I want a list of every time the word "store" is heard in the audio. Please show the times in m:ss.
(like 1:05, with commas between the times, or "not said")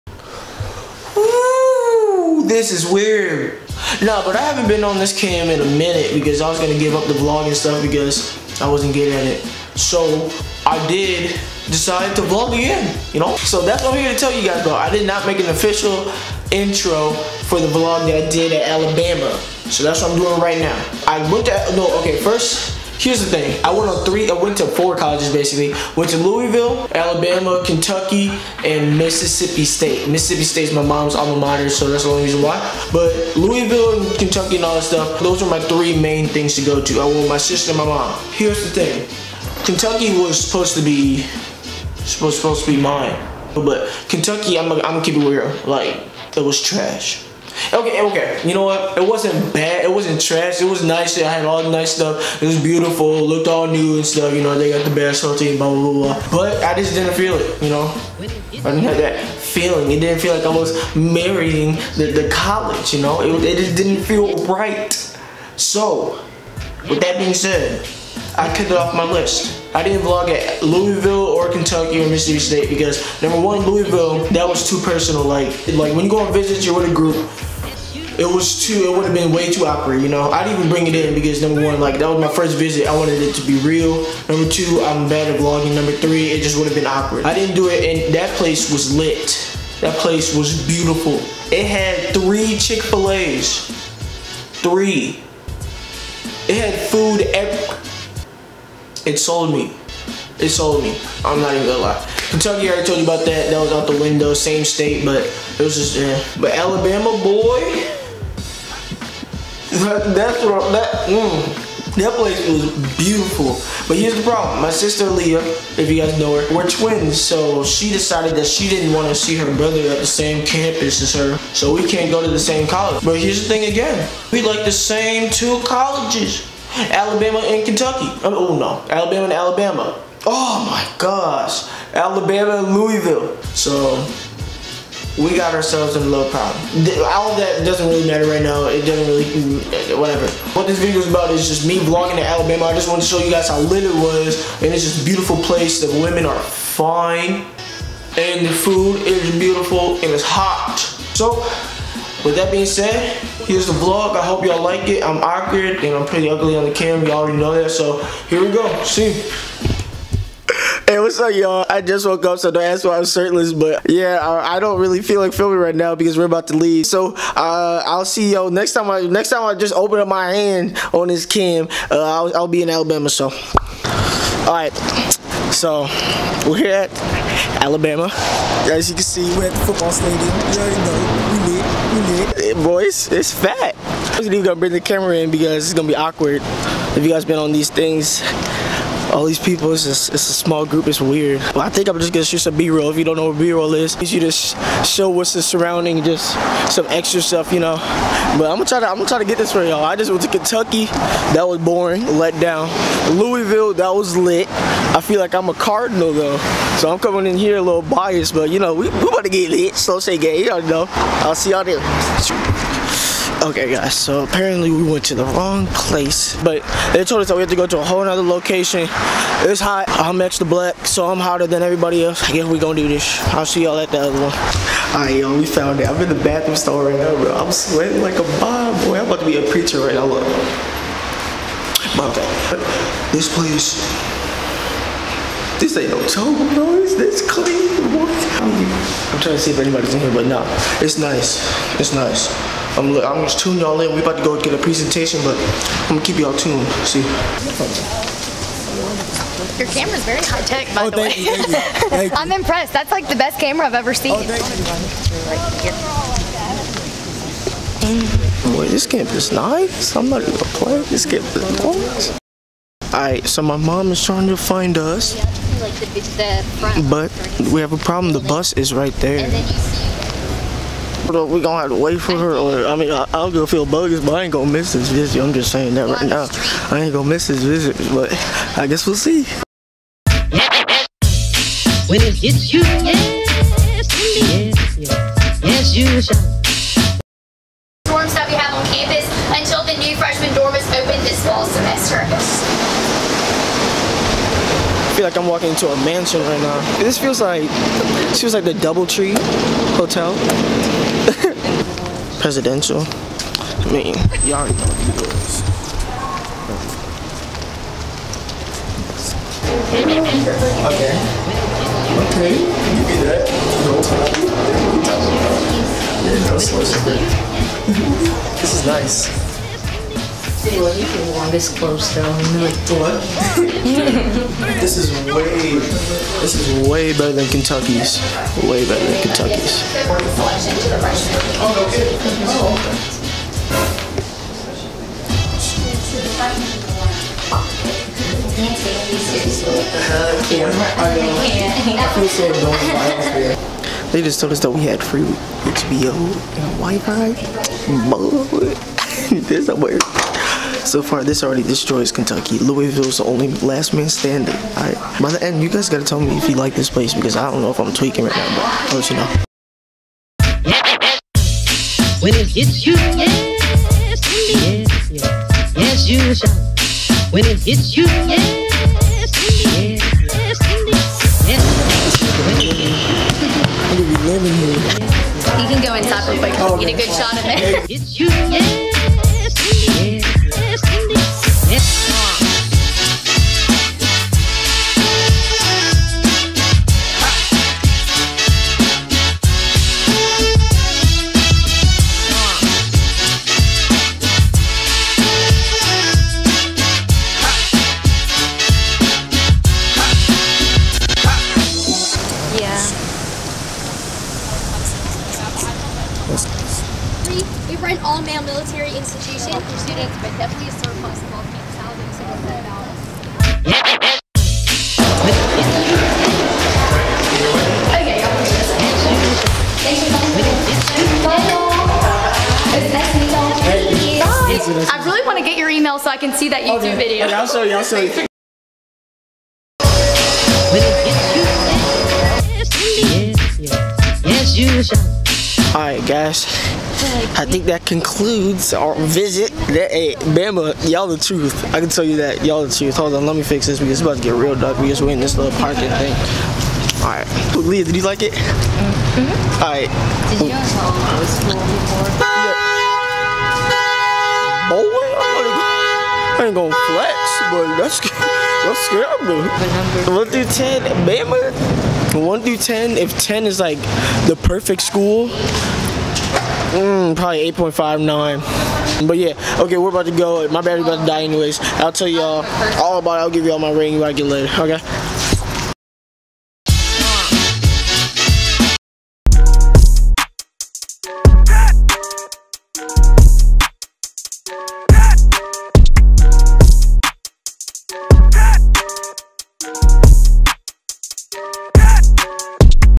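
3:46.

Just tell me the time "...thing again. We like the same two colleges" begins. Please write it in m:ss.
2:03.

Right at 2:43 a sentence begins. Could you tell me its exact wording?
But yeah, I, I don't really feel like filming right now because we're about to leave.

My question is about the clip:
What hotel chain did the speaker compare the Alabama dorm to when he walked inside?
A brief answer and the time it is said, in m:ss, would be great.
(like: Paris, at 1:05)
DoubleTree, at 4:58.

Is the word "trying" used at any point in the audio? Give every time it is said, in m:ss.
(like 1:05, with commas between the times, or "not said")
3:59, 4:24.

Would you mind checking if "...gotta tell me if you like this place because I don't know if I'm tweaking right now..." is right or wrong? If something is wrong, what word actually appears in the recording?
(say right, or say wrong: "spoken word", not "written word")
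right.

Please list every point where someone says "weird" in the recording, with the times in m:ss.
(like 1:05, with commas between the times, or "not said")
0:02, 3:11.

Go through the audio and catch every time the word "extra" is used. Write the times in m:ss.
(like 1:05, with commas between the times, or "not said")
3:16, 3:40.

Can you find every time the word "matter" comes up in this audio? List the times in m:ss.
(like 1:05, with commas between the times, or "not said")
2:18.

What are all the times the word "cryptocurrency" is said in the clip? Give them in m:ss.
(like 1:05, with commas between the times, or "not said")
not said.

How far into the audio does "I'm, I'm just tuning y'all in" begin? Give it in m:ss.
4:02.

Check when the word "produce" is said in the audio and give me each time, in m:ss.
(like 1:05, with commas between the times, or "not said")
not said.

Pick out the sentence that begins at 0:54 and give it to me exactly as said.
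You know, they got the best hotel.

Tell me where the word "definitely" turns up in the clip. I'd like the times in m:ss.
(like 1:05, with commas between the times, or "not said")
6:50.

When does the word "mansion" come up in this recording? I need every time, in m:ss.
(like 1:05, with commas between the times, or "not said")
4:55.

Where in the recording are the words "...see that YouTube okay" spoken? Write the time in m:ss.
7:06.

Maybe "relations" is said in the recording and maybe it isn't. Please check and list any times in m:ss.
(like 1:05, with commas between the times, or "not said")
not said.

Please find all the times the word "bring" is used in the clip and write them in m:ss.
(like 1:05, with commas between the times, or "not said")
1:20, 3:04.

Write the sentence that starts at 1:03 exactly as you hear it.
It, it just didn't feel right.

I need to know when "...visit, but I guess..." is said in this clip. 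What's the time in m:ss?
4:37.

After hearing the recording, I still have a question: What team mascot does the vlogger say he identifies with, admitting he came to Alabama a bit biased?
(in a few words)
Cardinal.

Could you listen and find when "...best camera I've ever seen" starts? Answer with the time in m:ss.
4:13.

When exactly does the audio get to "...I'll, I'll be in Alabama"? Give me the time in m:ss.
2:51.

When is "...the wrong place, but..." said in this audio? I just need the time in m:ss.
3:35.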